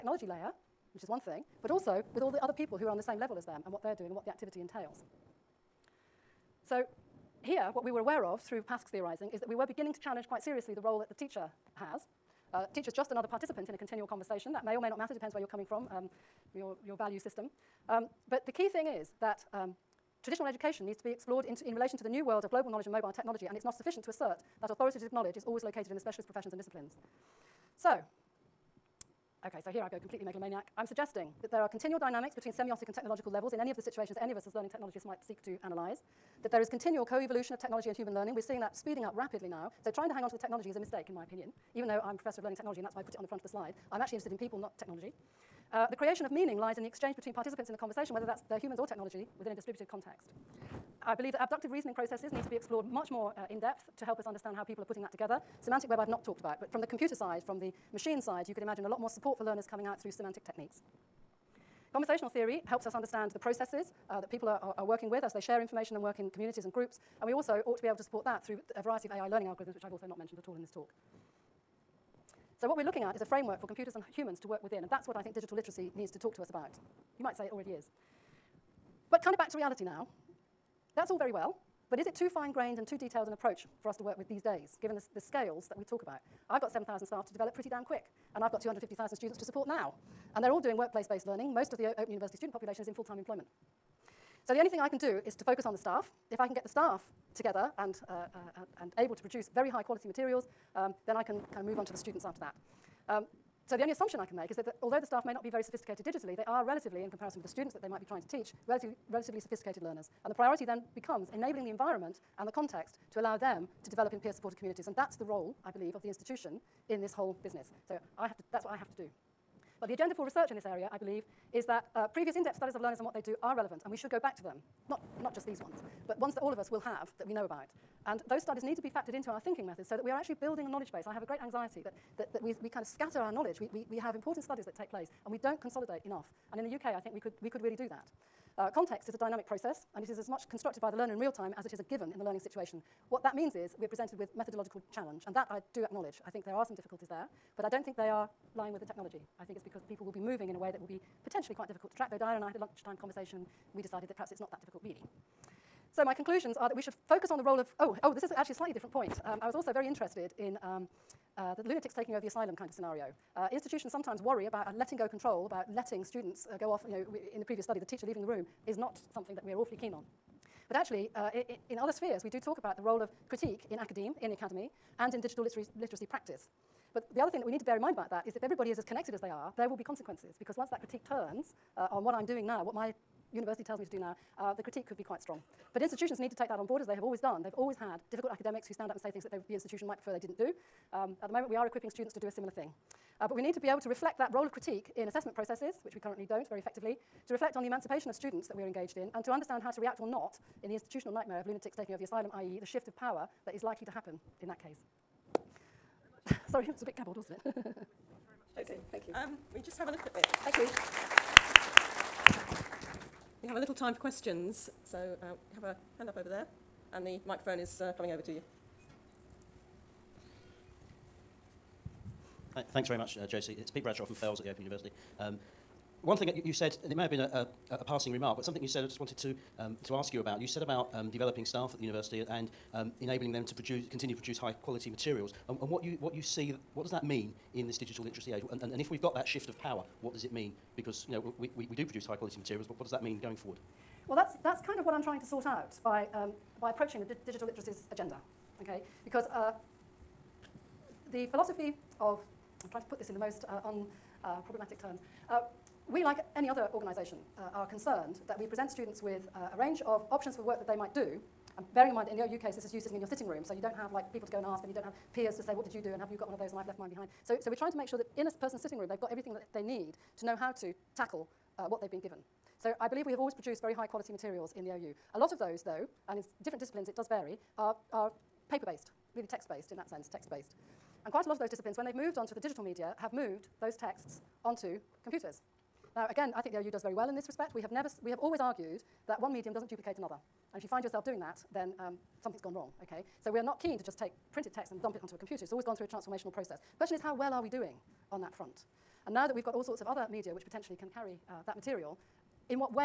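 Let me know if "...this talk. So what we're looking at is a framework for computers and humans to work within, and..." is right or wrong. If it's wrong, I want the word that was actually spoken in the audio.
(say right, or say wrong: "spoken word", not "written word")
right.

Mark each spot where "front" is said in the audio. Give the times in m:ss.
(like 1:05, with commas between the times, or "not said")
0:43, 4:58.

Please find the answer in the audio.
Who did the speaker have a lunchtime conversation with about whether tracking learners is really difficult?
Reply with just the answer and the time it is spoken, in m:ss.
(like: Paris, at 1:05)
Diana, at 2:32.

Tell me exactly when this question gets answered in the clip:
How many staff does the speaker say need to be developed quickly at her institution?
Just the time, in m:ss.
1:26.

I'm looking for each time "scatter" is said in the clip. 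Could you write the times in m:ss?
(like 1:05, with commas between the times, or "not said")
2:12.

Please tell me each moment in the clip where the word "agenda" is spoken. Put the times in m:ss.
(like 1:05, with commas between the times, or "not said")
1:59, 4:07.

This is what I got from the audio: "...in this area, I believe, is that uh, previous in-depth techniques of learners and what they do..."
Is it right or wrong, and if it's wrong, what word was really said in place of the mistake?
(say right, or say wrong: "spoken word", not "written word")
wrong: "studies", not "techniques".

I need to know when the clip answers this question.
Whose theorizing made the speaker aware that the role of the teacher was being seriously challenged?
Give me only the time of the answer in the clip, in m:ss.
0:08.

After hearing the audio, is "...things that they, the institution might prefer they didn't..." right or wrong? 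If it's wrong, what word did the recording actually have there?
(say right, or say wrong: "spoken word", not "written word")
right.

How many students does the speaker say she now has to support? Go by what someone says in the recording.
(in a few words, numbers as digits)
250,000.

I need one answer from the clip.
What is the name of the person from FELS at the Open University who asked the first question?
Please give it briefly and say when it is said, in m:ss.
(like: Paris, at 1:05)
Pete Bradshaw, at 3:43.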